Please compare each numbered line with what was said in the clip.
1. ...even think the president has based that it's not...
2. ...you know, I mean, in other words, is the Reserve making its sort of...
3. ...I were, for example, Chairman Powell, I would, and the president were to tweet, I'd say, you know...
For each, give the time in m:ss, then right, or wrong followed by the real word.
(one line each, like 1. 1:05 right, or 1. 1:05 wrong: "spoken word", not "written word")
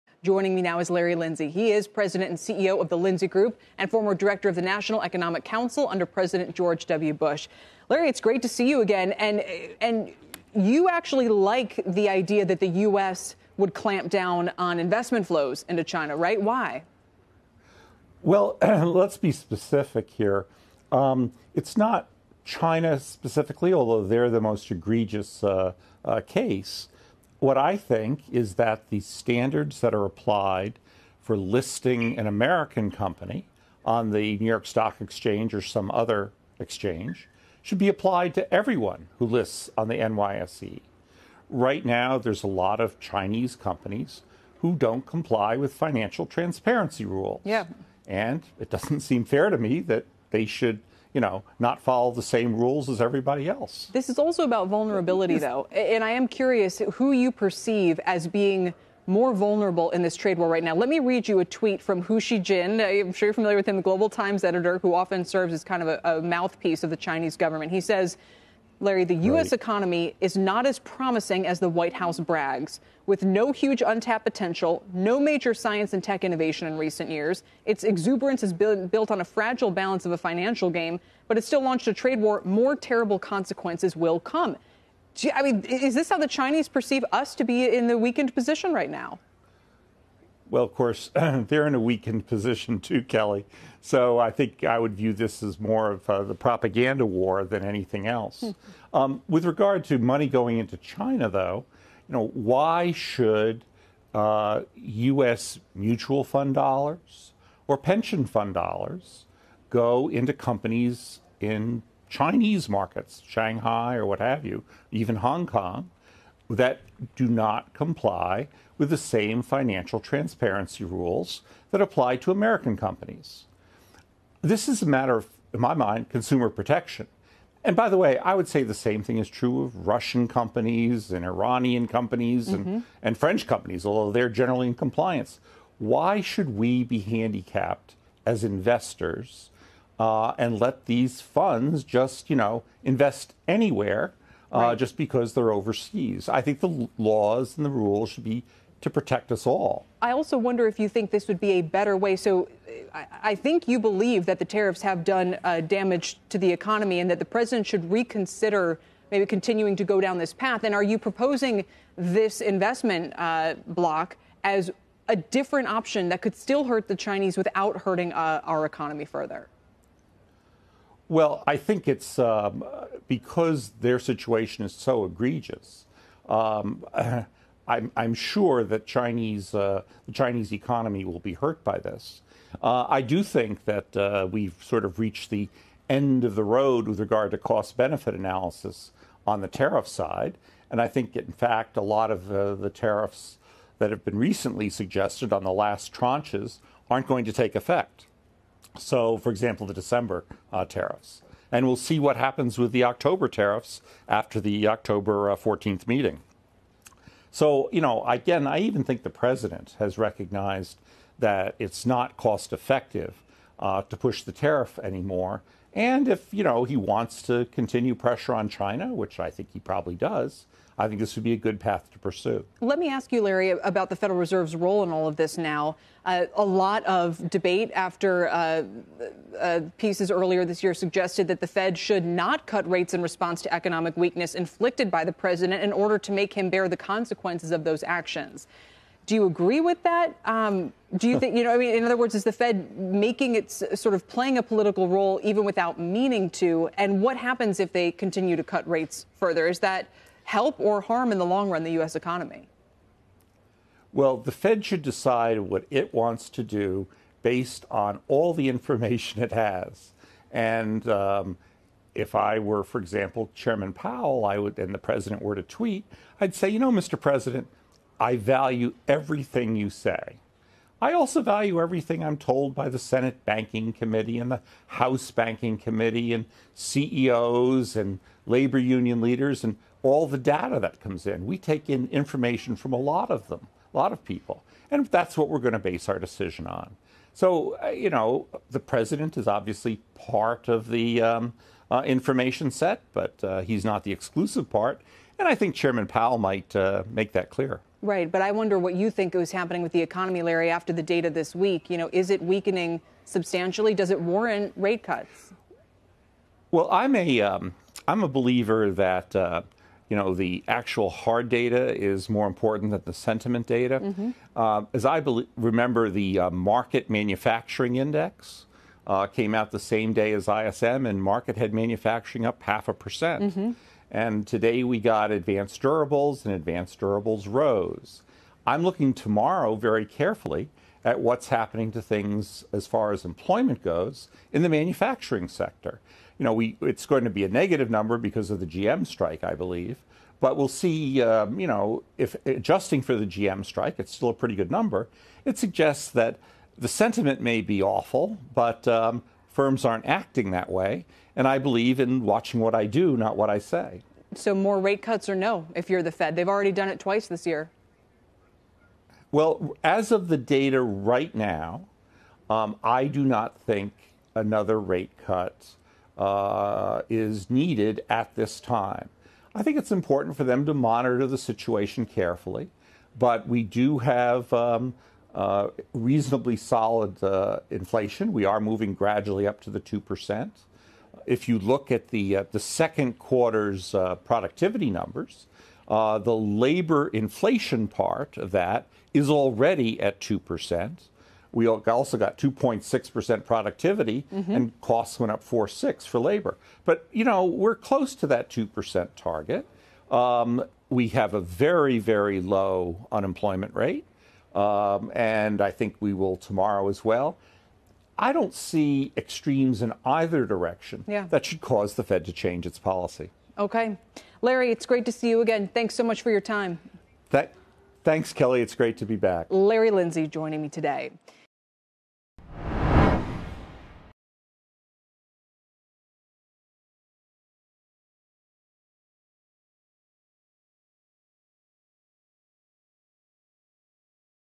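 1. 3:28 wrong: "recognized", not "based"
2. 4:01 wrong: "Fed", not "Reserve"
3. 4:22 right.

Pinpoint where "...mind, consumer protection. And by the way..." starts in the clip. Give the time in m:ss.
2:05.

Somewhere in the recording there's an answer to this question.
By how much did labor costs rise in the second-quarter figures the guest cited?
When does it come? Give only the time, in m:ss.
6:35.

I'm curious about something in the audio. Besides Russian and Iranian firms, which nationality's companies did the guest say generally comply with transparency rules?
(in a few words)
French.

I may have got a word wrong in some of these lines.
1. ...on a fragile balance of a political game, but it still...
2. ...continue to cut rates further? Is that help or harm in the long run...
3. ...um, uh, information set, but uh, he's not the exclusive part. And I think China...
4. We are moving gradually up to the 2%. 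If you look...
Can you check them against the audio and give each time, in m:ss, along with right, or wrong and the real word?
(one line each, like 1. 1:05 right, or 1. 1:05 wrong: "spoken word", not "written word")
1. 1:19 wrong: "financial", not "political"
2. 4:07 right
3. 4:51 wrong: "Chairman", not "China"
4. 6:18 right.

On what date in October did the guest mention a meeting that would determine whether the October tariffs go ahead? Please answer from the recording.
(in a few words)
October 14.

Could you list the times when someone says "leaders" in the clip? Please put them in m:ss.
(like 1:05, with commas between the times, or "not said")
4:39.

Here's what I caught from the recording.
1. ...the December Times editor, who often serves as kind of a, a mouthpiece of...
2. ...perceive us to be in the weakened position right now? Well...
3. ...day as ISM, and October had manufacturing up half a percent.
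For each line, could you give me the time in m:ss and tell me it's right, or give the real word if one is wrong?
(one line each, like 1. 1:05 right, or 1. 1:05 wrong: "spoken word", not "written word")
1. 1:03 wrong: "Global", not "December"
2. 1:26 right
3. 5:19 wrong: "Markit", not "October".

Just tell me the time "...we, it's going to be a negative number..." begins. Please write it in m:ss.
5:36.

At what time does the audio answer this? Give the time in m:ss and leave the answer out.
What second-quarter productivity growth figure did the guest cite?
6:32.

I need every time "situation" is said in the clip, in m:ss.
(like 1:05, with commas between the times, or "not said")
2:53, 6:11.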